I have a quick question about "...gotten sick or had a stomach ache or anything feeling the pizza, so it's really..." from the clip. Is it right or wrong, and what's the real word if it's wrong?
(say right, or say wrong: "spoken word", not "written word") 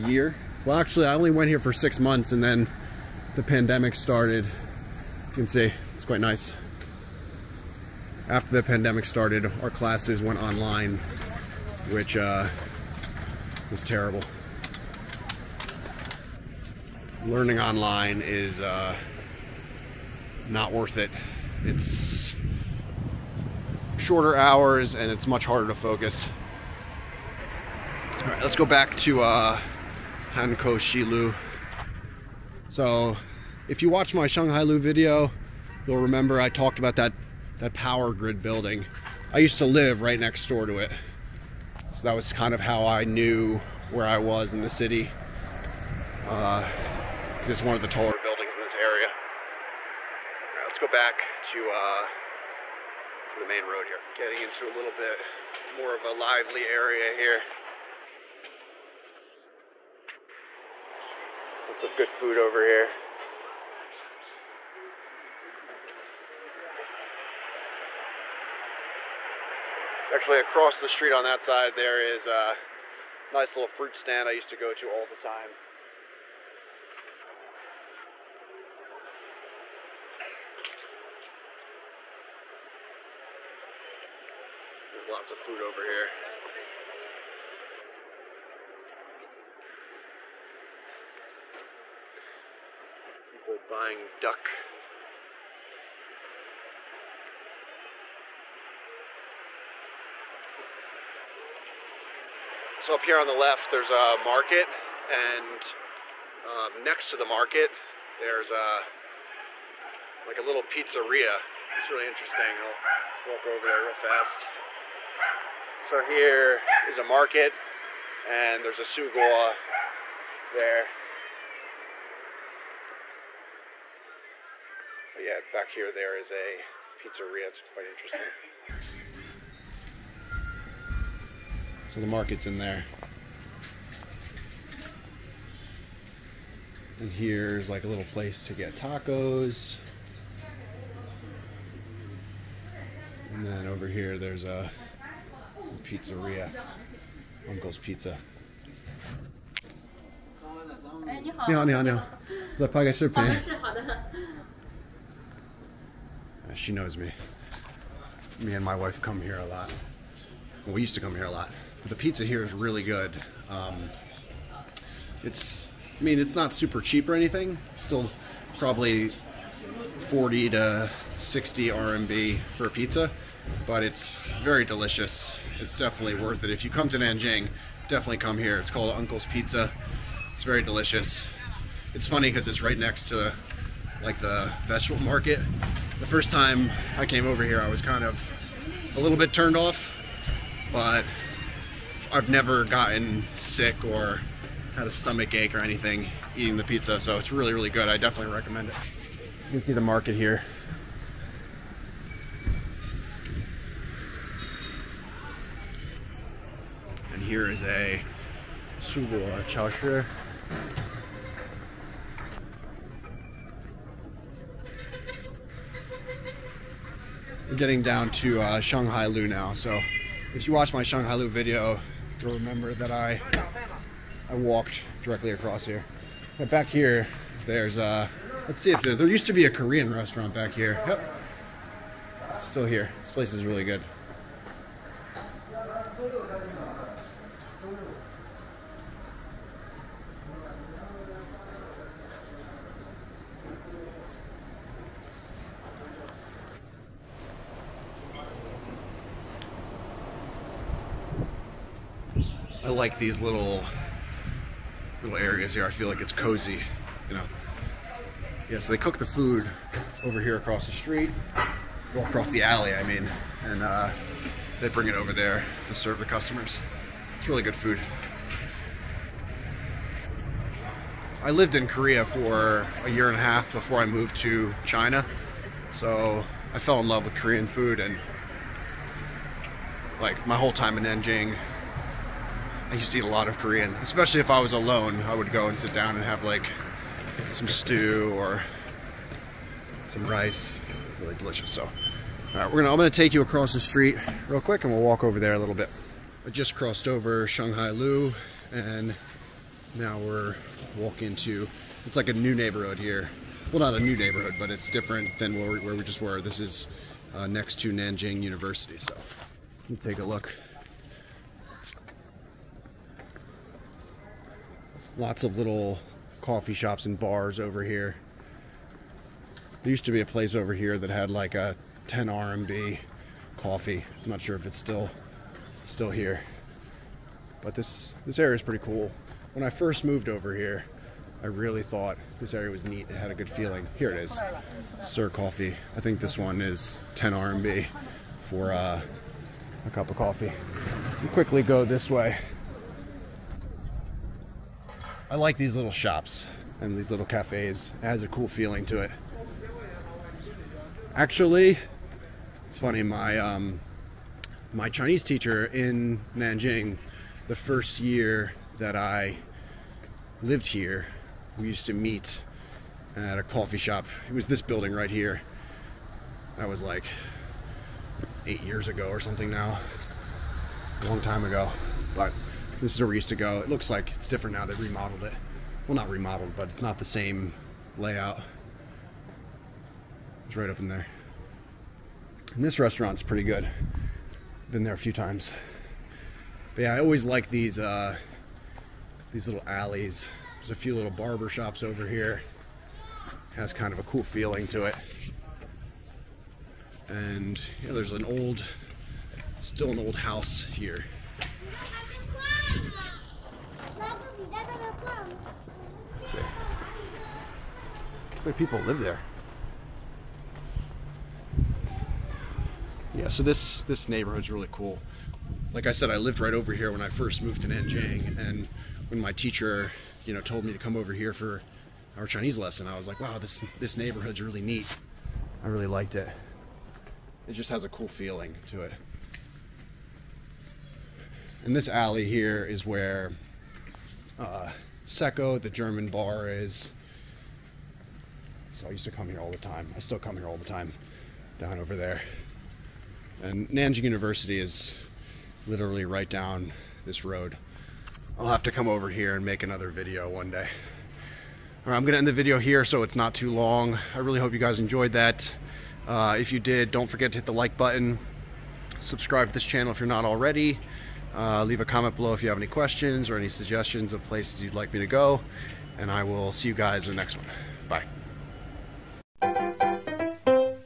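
wrong: "eating", not "feeling".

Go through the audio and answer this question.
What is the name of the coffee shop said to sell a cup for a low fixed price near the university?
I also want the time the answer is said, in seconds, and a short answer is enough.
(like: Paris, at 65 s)
Sir Coffee, at 334 s.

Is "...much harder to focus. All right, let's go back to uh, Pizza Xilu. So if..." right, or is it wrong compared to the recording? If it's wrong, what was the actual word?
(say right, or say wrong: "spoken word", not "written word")
wrong: "Hankou", not "Pizza".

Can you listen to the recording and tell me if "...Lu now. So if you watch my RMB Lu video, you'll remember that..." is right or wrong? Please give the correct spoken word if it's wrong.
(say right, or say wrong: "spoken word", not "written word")
wrong: "Shanghai", not "RMB".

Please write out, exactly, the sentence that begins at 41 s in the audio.
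So that was kind of how I knew where I was in the city.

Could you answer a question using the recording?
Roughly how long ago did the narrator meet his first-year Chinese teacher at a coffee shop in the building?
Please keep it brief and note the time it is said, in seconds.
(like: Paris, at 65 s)
8 years ago, at 368 s.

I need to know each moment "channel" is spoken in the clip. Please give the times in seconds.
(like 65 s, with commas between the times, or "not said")
459 s.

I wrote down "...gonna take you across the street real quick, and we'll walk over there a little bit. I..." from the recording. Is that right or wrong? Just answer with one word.
right.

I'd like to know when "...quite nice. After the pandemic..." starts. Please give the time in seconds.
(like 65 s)
6 s.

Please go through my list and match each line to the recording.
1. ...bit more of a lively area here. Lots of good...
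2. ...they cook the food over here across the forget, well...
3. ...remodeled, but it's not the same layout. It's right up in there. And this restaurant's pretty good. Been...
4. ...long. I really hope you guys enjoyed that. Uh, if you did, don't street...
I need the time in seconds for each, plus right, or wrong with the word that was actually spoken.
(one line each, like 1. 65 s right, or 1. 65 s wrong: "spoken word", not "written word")
1. 54 s right
2. 258 s wrong: "street", not "forget"
3. 375 s right
4. 453 s wrong: "forget", not "street".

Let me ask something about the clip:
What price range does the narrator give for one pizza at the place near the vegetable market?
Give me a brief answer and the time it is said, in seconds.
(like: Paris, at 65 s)
40 to 60 RMB, at 170 s.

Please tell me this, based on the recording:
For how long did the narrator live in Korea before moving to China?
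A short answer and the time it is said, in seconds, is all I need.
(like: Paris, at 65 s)
a year and a half, at 272 s.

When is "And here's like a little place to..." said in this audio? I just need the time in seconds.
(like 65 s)
136 s.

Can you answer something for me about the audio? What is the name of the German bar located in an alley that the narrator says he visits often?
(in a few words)
Secco.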